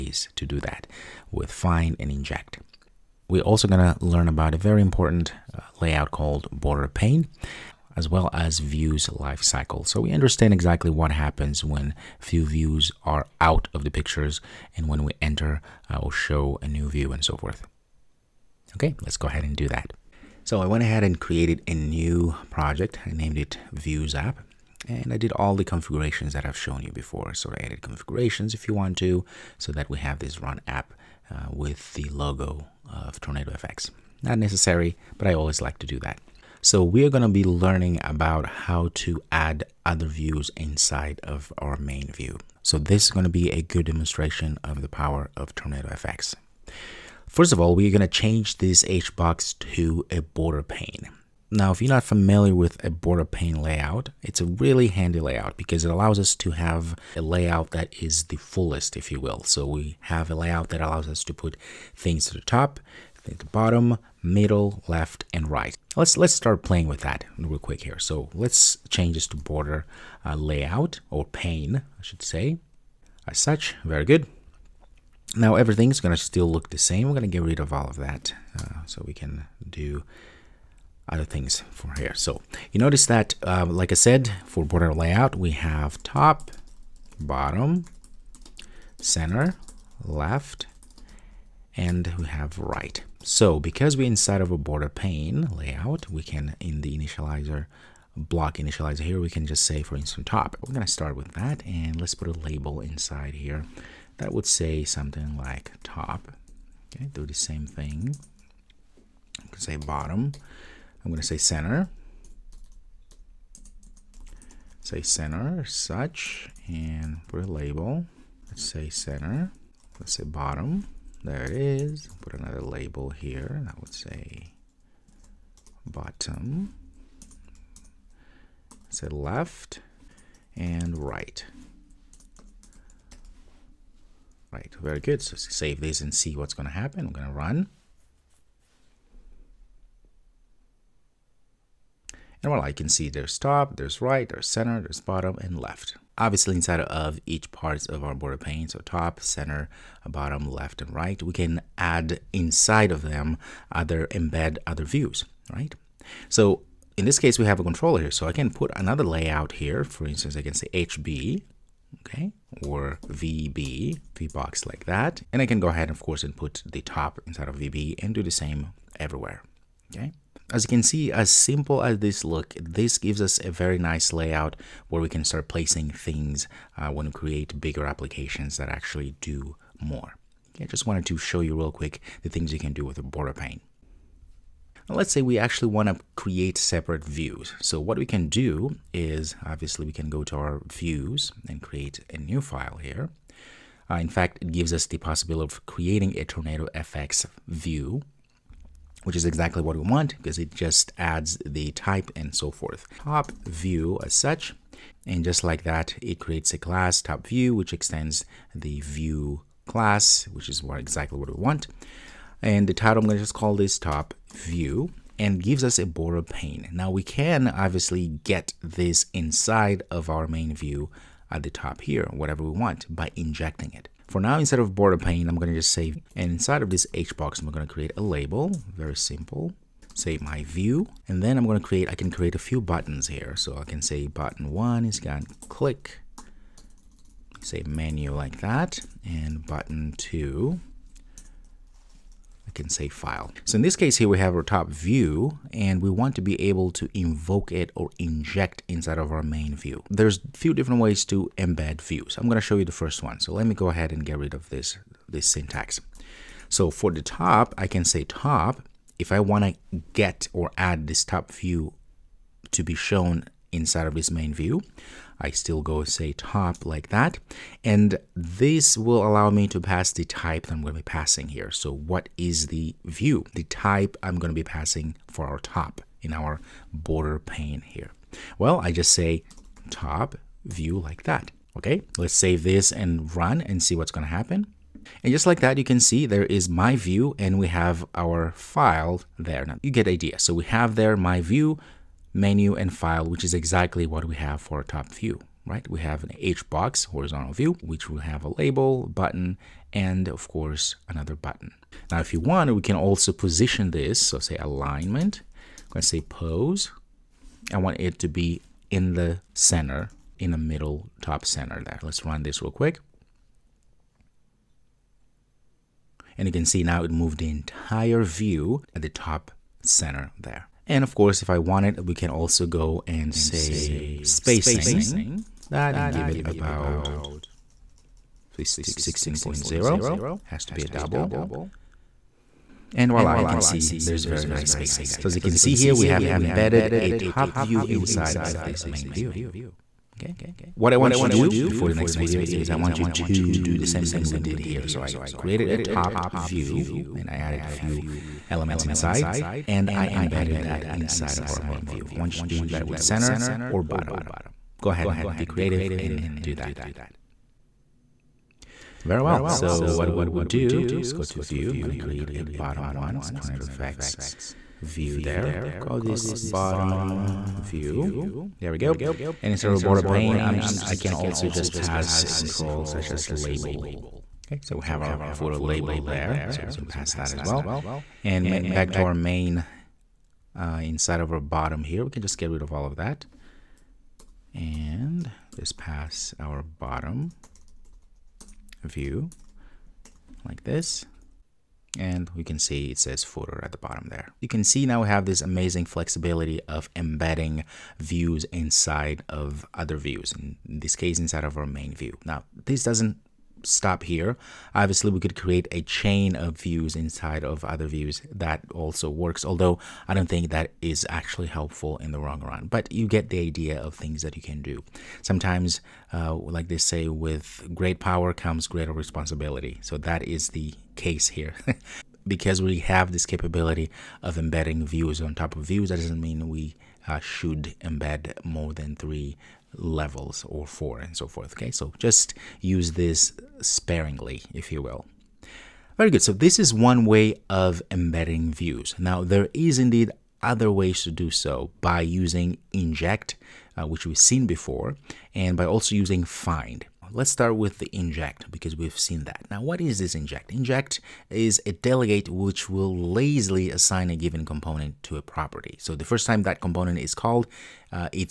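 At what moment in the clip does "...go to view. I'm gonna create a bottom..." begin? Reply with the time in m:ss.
6:00.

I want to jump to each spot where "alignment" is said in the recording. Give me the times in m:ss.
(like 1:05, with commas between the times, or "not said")
5:04.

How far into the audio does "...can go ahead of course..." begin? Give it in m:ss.
2:45.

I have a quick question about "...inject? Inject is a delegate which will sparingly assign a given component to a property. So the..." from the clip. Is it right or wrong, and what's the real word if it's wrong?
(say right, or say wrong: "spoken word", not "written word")
wrong: "lazily", not "sparingly".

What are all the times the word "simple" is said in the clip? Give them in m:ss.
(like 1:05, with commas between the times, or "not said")
2:51, 3:48.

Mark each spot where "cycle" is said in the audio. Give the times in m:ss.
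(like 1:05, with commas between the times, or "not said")
0:09.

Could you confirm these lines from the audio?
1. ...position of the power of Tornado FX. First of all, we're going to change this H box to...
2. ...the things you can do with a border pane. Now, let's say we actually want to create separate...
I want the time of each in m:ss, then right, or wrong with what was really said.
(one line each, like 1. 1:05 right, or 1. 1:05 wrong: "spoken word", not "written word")
1. 0:43 wrong: "demonstration", not "position"
2. 3:02 right.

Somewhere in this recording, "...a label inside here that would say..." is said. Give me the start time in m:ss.
1:42.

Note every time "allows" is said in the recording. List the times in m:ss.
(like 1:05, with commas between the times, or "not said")
0:55, 1:00, 4:29.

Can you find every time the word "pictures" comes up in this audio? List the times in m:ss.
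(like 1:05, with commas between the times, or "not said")
0:13.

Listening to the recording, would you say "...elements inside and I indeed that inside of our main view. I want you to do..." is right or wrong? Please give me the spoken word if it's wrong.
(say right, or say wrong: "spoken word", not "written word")
wrong: "embedded", not "indeed".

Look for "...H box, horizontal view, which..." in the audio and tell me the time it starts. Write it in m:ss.
4:56.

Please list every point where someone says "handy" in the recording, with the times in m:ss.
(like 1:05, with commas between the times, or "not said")
0:54.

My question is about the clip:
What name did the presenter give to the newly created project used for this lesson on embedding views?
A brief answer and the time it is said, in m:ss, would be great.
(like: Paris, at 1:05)
Views App, at 0:23.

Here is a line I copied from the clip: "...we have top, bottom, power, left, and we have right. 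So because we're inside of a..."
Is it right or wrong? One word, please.
wrong.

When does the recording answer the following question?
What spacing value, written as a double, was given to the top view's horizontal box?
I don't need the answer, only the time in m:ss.
5:28.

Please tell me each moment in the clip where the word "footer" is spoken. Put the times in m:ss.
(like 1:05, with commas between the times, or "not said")
6:15, 6:33.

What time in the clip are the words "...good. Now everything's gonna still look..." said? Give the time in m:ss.
1:14.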